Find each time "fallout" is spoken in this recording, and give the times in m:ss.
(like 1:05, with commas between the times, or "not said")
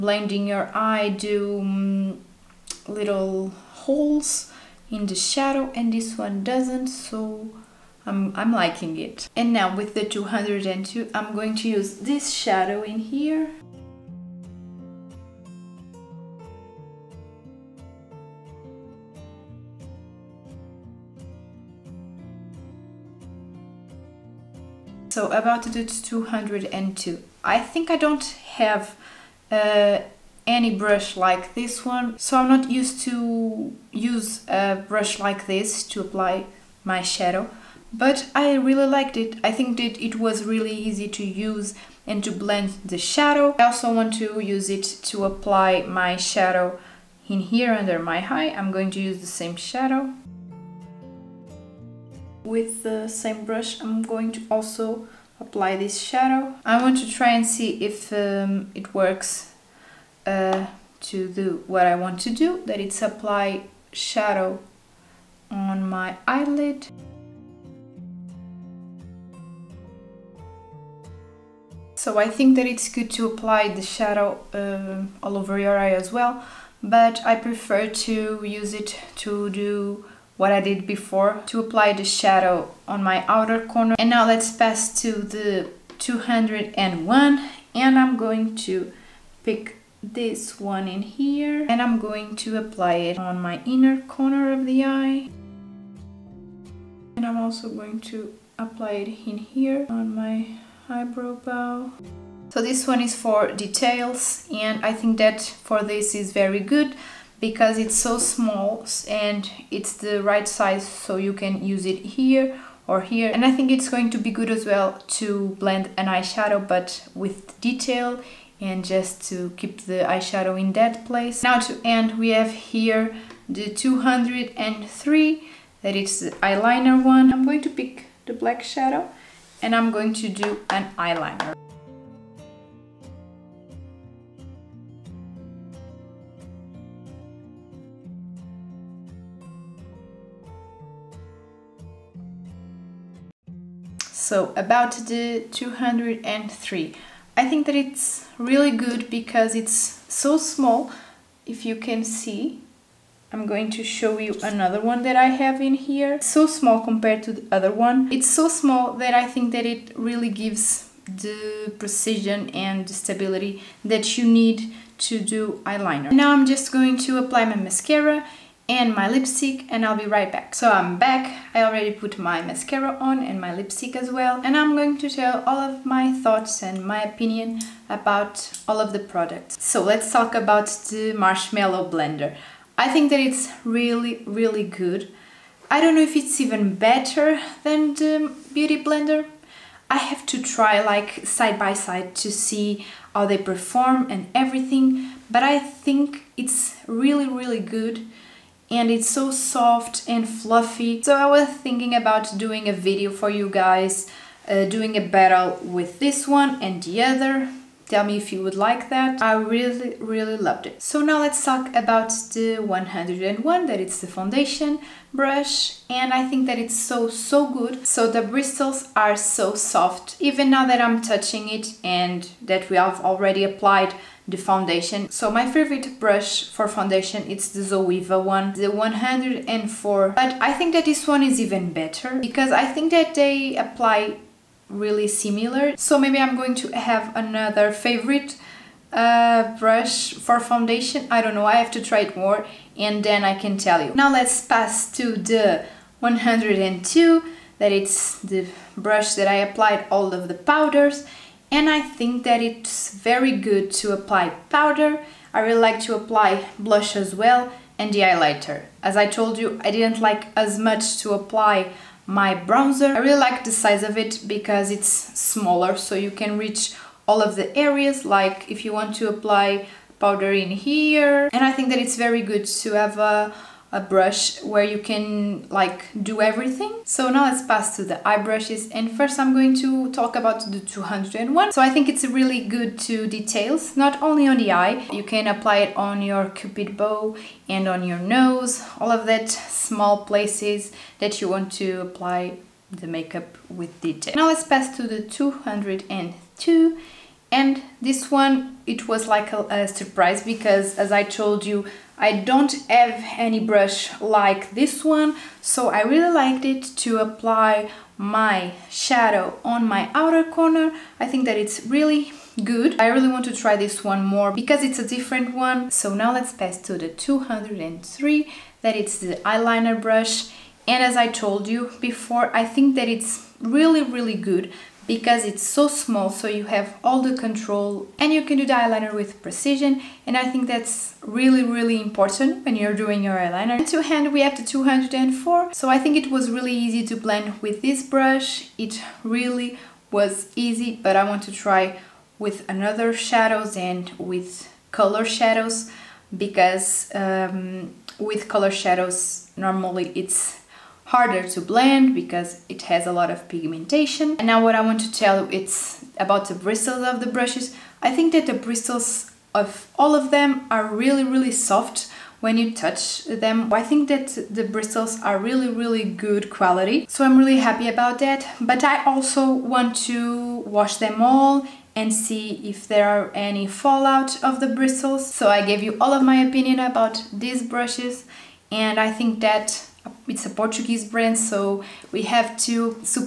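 6:13.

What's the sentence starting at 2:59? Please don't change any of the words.
So let's talk about the Marshmallow Blender.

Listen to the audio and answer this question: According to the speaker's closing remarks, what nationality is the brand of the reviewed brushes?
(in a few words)
Portuguese.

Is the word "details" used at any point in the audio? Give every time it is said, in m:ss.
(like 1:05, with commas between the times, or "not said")
1:43, 1:57, 4:43, 4:53.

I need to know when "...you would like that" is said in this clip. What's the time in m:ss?
3:28.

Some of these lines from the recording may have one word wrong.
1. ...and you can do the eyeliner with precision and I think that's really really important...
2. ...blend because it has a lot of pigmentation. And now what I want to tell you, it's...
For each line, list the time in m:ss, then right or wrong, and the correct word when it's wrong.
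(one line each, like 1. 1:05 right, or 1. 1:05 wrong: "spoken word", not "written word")
1. 5:27 right
2. 5:51 right.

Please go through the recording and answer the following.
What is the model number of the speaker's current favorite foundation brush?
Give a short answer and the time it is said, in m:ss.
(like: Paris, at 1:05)
104, at 3:48.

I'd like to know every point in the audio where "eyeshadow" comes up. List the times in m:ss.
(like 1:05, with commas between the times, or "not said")
1:56, 2:00.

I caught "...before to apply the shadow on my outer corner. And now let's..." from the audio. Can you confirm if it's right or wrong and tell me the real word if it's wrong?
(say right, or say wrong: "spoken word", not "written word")
right.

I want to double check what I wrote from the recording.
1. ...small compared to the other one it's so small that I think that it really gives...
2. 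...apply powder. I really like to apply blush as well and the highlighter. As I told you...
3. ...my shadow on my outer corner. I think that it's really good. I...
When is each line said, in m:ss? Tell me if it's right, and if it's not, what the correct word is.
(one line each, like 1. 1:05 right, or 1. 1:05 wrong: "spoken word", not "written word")
1. 2:36 right
2. 4:13 right
3. 5:07 right.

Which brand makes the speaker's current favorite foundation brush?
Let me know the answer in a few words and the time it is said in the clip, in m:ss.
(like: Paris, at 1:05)
Zoeva, at 3:47.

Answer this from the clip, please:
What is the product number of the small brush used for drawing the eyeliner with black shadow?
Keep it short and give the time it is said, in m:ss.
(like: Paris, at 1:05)
203, at 2:03.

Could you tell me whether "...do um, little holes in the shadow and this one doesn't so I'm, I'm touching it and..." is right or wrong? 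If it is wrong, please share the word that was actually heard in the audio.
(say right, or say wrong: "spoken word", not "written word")
wrong: "liking", not "touching".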